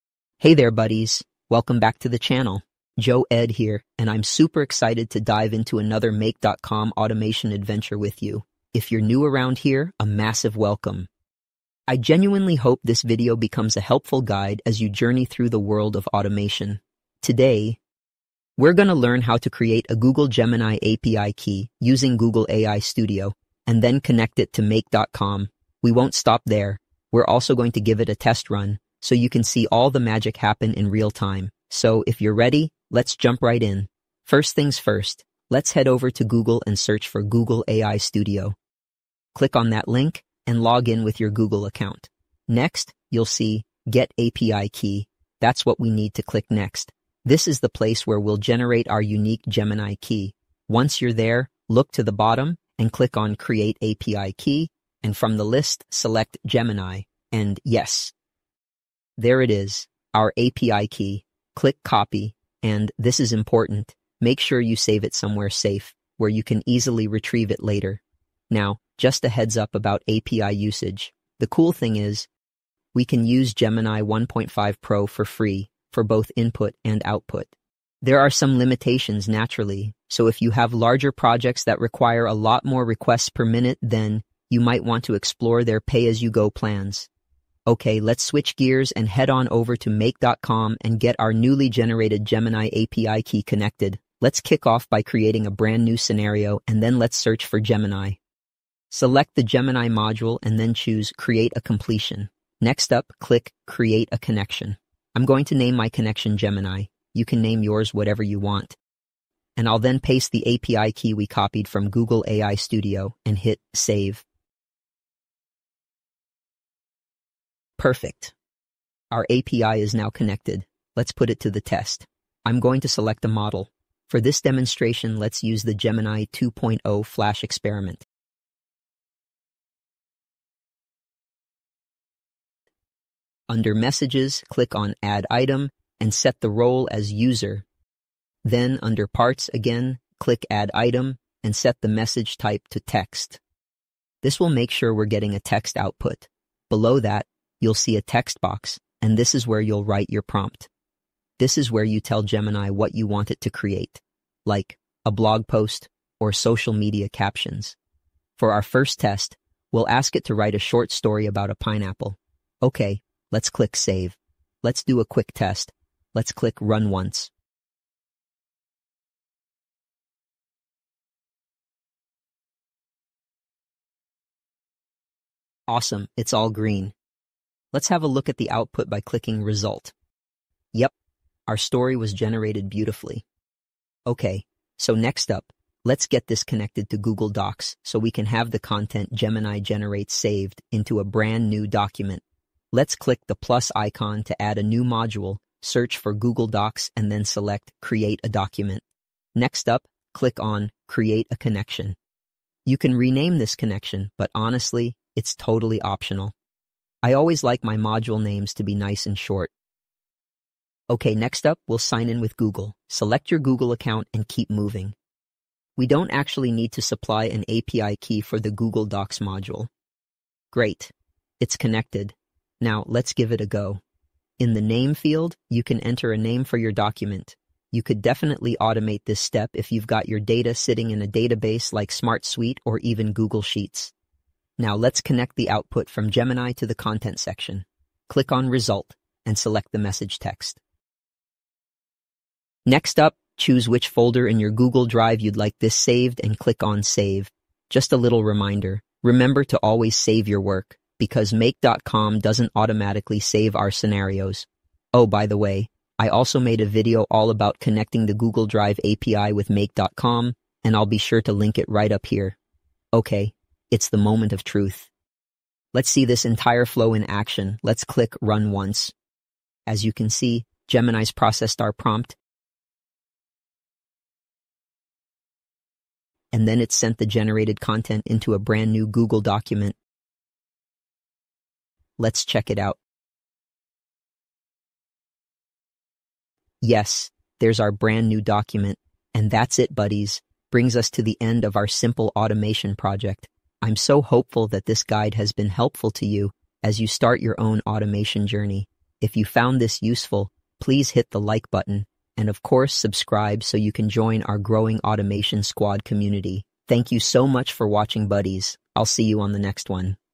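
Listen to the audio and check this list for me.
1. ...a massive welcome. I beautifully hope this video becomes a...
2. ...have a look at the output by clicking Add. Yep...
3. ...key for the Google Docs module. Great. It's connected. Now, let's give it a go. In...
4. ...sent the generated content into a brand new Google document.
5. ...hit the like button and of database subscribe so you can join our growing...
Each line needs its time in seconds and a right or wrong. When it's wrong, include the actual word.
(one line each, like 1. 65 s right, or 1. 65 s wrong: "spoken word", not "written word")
1. 9 s wrong: "genuinely", not "beautifully"
2. 177 s wrong: "Result", not "Add"
3. 217 s right
4. 276 s right
5. 300 s wrong: "course", not "database".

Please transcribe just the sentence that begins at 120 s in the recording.
Let's put it to the test.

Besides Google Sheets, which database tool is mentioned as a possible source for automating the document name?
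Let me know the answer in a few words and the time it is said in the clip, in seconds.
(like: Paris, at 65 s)
SmartSuite, at 231 s.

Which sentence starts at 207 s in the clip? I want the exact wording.
I always like my module names to be nice and short.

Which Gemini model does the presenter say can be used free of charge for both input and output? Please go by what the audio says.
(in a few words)
Gemini 1.5 Pro.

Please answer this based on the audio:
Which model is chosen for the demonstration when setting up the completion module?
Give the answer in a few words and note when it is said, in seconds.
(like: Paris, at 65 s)
Gemini 2.0 flash experiment, at 125 s.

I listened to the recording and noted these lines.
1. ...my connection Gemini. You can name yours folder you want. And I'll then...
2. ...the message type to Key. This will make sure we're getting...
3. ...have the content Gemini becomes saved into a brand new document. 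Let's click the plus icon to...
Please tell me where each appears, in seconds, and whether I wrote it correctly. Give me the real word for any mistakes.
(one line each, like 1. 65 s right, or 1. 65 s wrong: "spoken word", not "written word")
1. 105 s wrong: "whatever", not "folder"
2. 141 s wrong: "Text", not "Key"
3. 188 s wrong: "generates", not "becomes".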